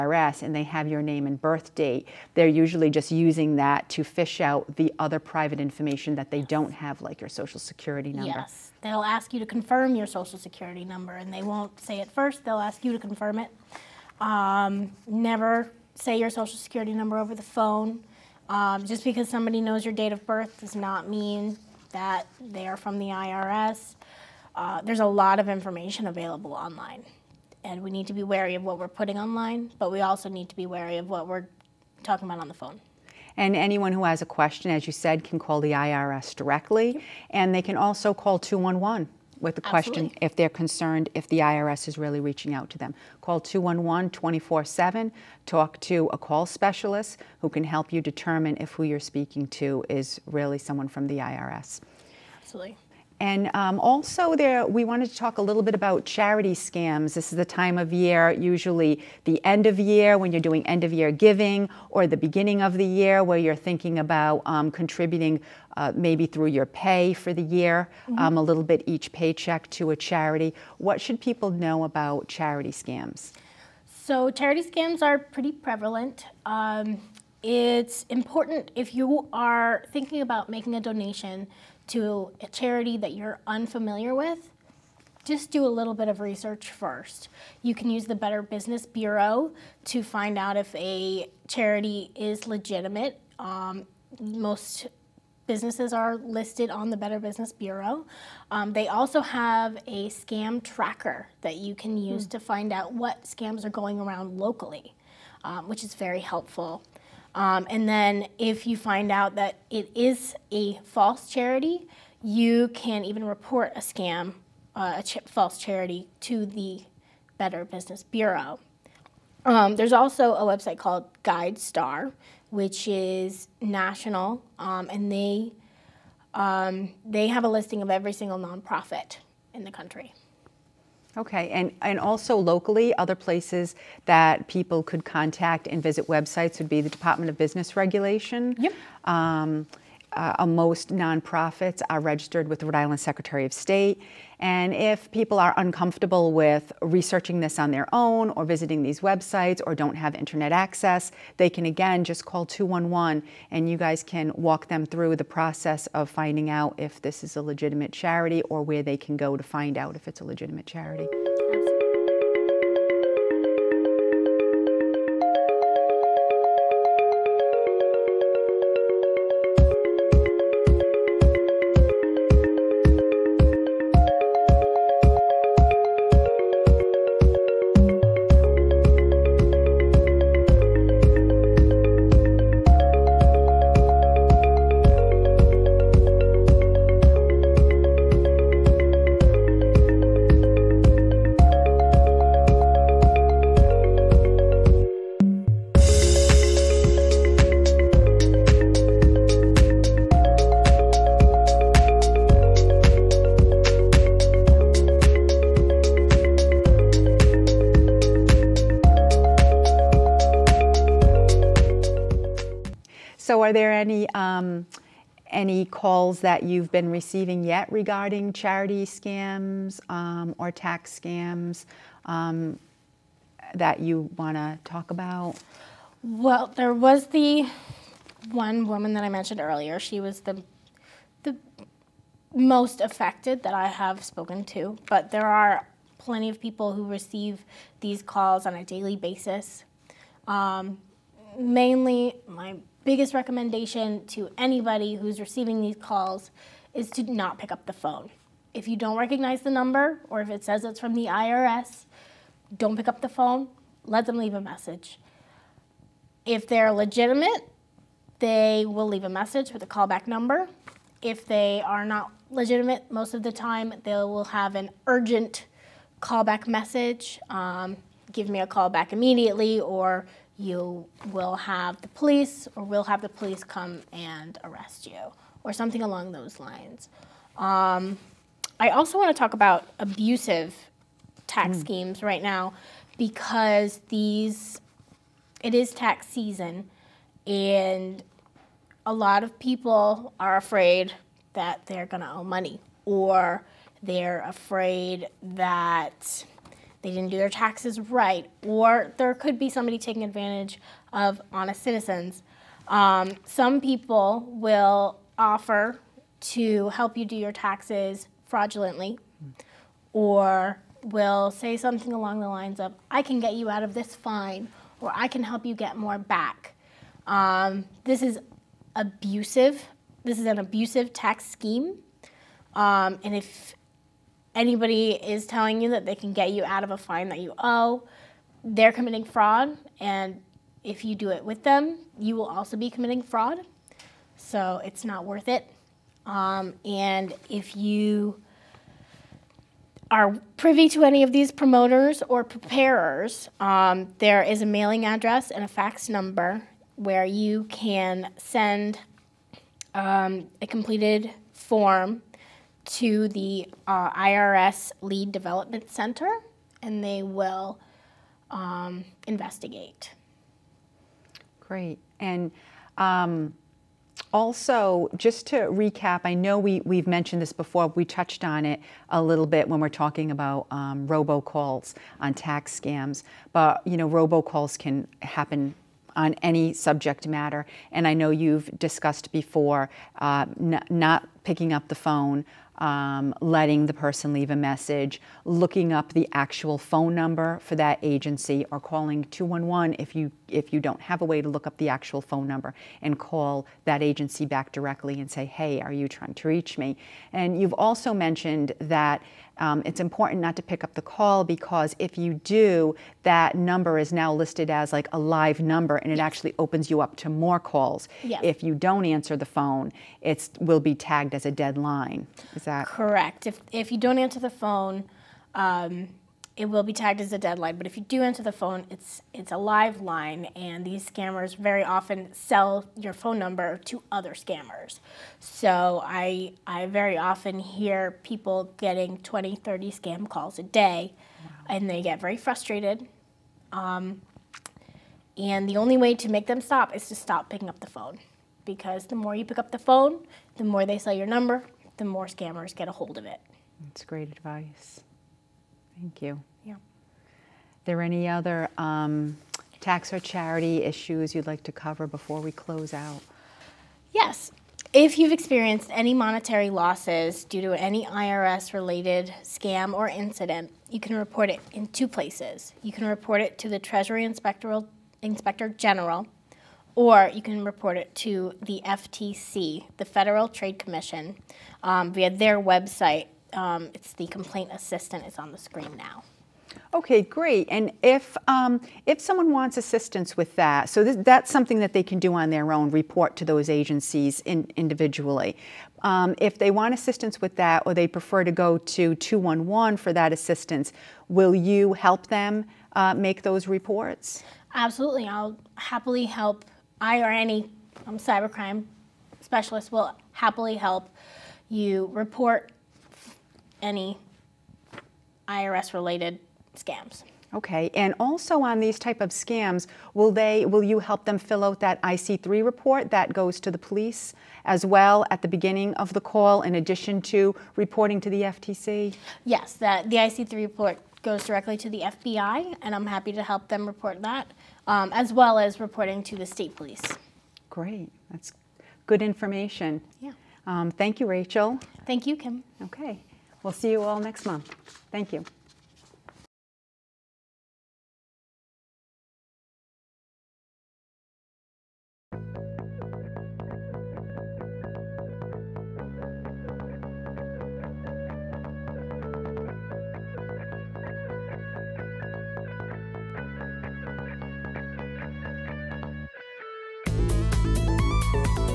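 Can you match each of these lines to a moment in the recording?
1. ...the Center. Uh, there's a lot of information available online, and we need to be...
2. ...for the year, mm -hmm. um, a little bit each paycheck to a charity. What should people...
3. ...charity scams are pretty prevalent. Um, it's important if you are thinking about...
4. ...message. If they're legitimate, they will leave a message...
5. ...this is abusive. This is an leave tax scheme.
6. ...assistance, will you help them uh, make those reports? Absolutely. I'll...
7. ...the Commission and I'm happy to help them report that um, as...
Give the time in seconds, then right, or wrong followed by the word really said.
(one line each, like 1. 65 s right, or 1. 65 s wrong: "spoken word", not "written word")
1. 22 s wrong: "IRS", not "Center"
2. 67 s right
3. 74 s right
4. 254 s right
5. 317 s wrong: "abusive", not "leave"
6. 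490 s right
7. 521 s wrong: "FBI", not "Commission".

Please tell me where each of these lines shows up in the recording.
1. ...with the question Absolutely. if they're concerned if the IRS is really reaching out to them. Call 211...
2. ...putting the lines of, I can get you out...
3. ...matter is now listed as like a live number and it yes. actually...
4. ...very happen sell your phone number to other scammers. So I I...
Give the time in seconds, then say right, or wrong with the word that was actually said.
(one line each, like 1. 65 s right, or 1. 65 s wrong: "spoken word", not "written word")
1. 39 s right
2. 311 s wrong: "along", not "putting"
3. 403 s wrong: "number", not "matter"
4. 421 s wrong: "often", not "happen".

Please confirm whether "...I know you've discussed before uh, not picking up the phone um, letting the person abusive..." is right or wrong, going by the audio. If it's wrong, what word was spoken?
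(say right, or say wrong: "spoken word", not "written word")
wrong: "leave", not "abusive".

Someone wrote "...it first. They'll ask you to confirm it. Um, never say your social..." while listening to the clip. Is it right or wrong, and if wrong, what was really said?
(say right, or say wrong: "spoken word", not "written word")
right.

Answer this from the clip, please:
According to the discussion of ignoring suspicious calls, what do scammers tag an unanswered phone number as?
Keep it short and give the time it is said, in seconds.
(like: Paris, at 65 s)
a dead line, at 411 s.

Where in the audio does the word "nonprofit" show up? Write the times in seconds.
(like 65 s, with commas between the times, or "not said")
128 s, 140 s.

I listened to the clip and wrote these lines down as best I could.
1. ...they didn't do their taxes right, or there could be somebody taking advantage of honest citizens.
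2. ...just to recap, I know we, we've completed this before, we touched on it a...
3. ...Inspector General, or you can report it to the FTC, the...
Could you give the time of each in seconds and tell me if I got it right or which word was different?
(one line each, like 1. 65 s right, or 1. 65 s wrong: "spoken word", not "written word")
1. 296 s right
2. 364 s wrong: "mentioned", not "completed"
3. 464 s right.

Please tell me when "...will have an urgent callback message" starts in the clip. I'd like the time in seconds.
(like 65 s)
263 s.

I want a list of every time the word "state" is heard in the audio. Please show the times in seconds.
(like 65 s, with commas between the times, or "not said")
143 s, 526 s.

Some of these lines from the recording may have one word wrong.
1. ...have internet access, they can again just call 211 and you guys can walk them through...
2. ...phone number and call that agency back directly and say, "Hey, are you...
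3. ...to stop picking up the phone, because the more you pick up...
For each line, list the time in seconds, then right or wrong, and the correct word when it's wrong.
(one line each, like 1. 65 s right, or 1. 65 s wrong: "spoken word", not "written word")
1. 149 s right
2. 392 s right
3. 436 s right.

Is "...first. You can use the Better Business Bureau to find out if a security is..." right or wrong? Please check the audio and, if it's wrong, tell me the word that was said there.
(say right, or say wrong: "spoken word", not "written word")
wrong: "charity", not "security".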